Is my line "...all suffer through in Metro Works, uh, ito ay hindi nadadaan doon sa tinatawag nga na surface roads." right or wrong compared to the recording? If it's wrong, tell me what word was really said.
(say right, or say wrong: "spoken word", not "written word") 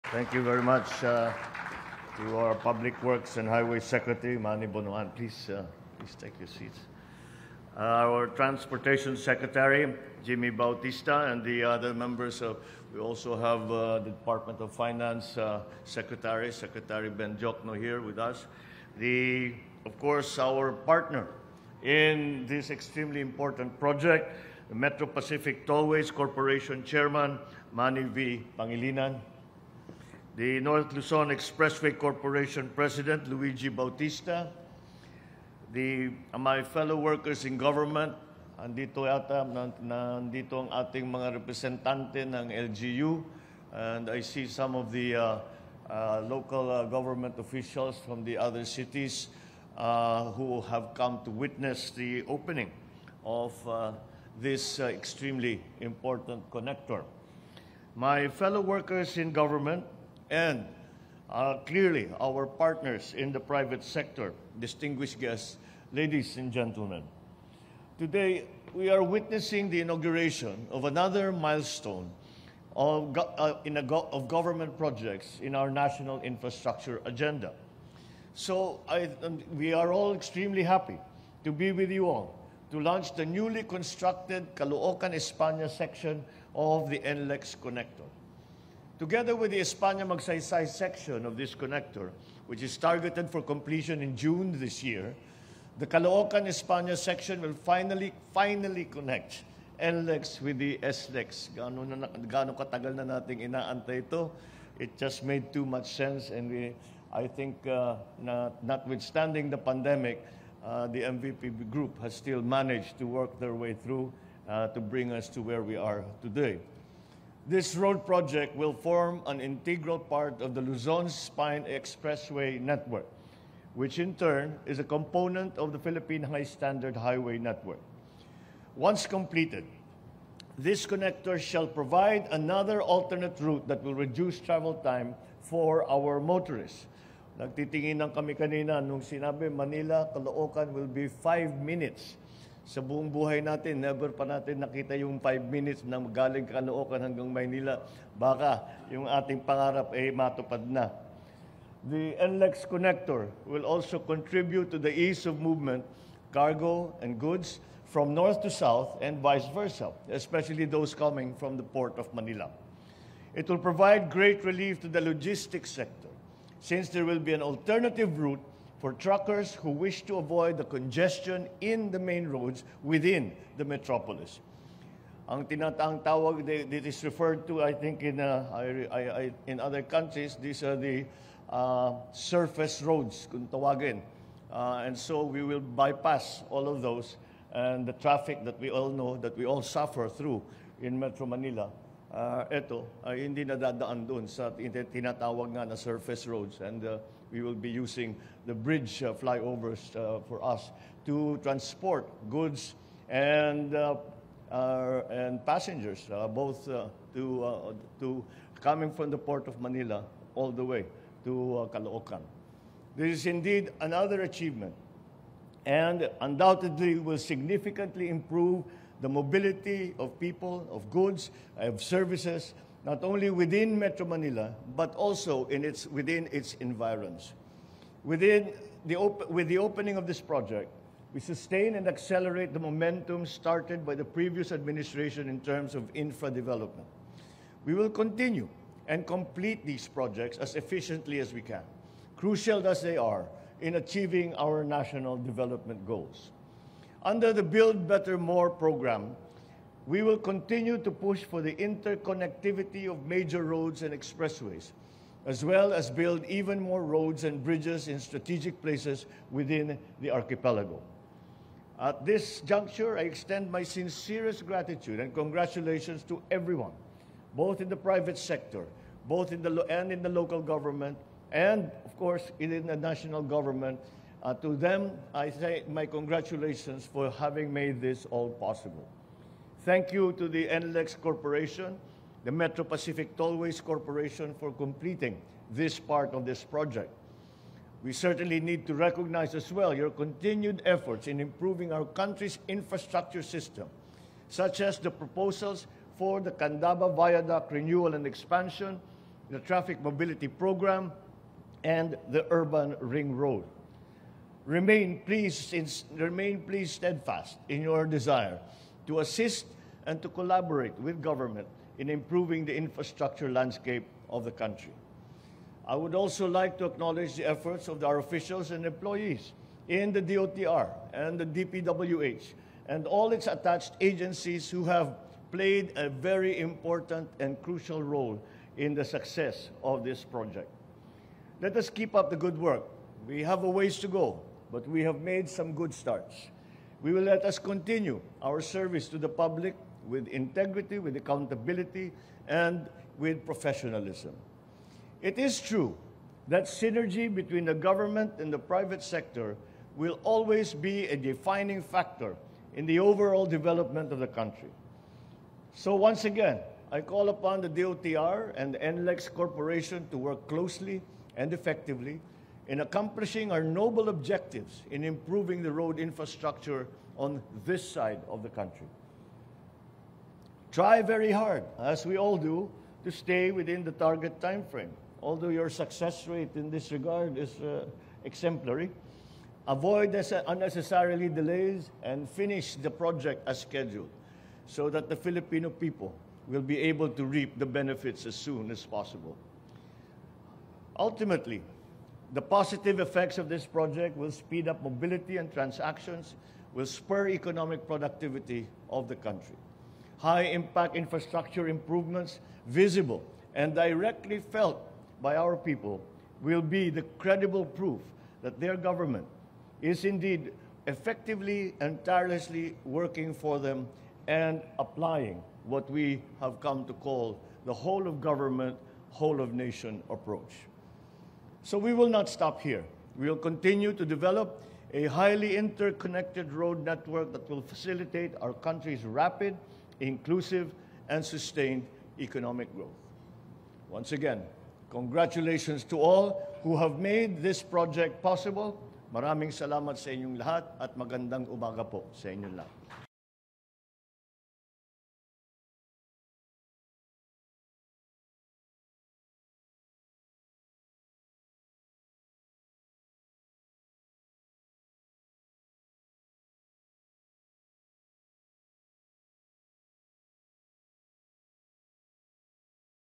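wrong: "Manila", not "Works".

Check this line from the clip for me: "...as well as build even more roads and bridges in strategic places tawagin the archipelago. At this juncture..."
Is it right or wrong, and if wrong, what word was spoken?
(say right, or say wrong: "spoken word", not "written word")
wrong: "within", not "tawagin".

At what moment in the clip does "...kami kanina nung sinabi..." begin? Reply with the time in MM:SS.
02:18.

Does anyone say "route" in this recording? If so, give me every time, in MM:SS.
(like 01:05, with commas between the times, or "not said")
02:13, 02:48.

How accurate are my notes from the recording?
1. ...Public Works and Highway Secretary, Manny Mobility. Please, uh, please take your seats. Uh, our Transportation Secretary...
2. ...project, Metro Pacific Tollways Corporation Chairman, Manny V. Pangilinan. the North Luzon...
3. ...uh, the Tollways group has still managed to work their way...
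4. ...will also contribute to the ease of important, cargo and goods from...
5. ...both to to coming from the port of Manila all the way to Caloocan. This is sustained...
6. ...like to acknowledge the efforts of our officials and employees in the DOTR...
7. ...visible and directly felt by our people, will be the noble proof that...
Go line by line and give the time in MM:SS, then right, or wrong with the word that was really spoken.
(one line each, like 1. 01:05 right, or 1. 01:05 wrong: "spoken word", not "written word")
1. 00:02 wrong: "Bonoan", not "Mobility"
2. 00:23 right
3. 01:50 wrong: "MVP", not "Tollways"
4. 02:33 wrong: "movement", not "important"
5. 03:26 wrong: "indeed", not "sustained"
6. 05:16 right
7. 06:42 wrong: "credible", not "noble".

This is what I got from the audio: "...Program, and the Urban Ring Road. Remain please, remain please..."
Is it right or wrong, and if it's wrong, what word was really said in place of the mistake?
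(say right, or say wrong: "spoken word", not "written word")
right.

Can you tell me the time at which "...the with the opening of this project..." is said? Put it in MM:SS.
03:48.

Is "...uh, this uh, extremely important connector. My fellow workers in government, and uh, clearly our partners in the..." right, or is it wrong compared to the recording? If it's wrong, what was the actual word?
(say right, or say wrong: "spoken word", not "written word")
right.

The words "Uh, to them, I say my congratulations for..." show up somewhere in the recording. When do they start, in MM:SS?
04:34.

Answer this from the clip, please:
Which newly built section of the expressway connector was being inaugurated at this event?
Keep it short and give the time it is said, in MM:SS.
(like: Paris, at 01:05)
Caloocan España section, at 01:24.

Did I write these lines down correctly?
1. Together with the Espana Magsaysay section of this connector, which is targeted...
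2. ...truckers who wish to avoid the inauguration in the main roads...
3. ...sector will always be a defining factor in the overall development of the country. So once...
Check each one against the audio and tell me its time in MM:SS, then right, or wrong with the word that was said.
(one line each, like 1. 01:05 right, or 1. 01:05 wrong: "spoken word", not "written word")
1. 01:29 right
2. 02:48 wrong: "congestion", not "inauguration"
3. 05:48 right.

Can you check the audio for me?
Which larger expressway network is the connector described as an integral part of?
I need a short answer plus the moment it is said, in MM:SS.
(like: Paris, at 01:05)
Luzon Spine Expressway network, at 02:00.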